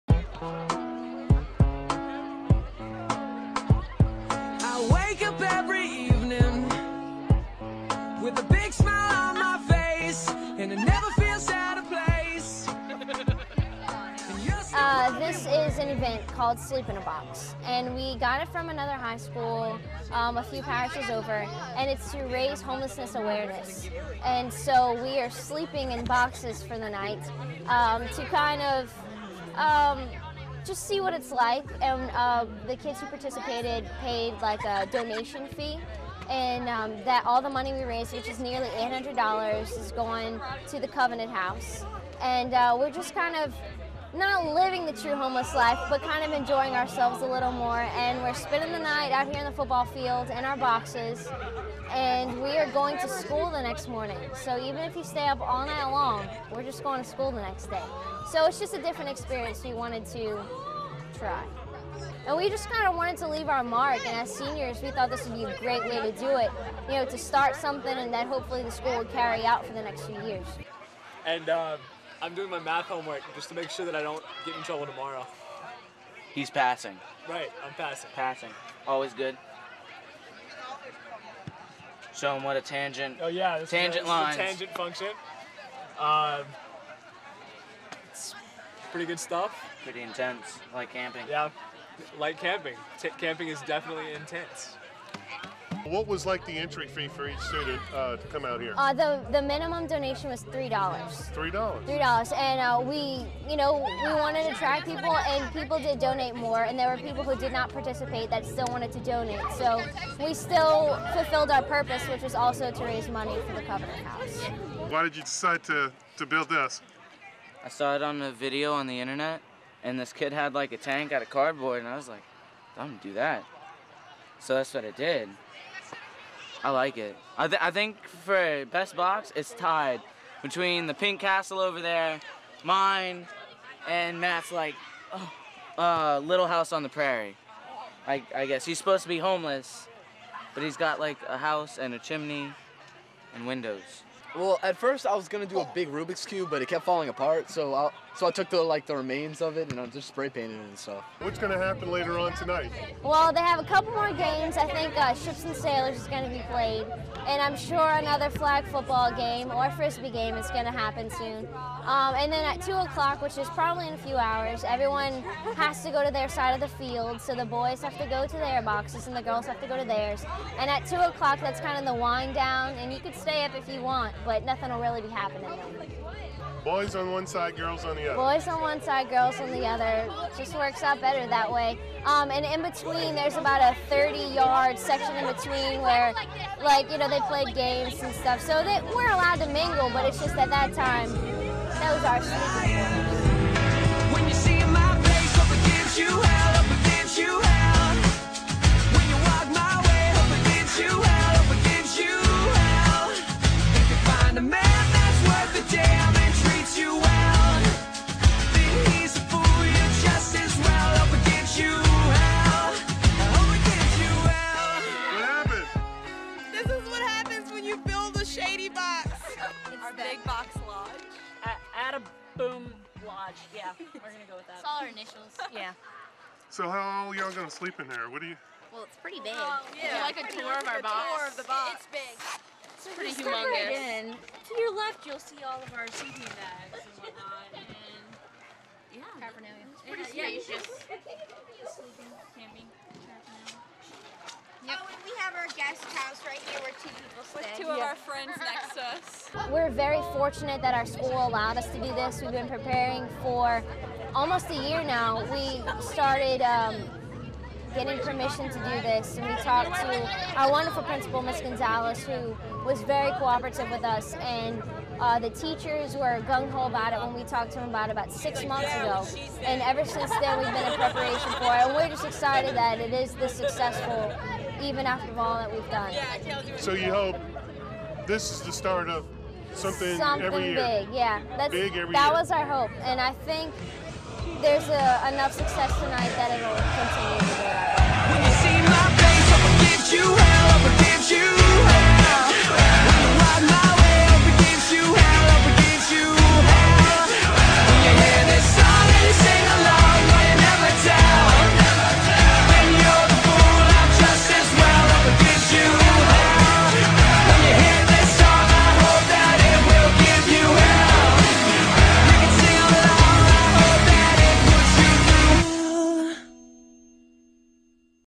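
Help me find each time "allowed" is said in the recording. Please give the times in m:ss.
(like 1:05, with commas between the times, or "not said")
3:09, 4:11.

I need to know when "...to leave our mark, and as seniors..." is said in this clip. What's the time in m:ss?
1:03.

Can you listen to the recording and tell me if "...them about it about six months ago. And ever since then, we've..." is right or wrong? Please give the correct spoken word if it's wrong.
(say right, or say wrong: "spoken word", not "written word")
right.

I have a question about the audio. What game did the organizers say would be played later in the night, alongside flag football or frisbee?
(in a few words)
Ships and Sailors.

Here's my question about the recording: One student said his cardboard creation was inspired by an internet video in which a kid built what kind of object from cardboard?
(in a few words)
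A tank.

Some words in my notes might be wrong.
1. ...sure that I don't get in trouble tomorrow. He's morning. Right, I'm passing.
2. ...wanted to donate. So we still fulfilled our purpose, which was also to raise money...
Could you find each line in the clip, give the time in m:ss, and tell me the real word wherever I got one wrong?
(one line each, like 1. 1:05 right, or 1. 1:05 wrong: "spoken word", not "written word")
1. 1:13 wrong: "passing", not "morning"
2. 1:48 right.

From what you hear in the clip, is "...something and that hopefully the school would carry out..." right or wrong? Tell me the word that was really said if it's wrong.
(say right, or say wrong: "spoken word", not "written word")
right.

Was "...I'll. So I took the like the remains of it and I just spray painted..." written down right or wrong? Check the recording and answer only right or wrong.
right.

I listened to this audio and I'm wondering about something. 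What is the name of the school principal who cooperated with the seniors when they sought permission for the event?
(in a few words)
Miss Gonzalez.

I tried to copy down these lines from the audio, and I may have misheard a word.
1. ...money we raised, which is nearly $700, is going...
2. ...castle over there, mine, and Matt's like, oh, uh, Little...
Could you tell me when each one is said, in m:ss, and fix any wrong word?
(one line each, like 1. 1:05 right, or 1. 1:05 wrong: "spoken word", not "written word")
1. 0:37 wrong: "800", not "700"
2. 2:11 right.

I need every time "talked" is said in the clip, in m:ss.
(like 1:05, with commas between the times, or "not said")
4:19, 4:27.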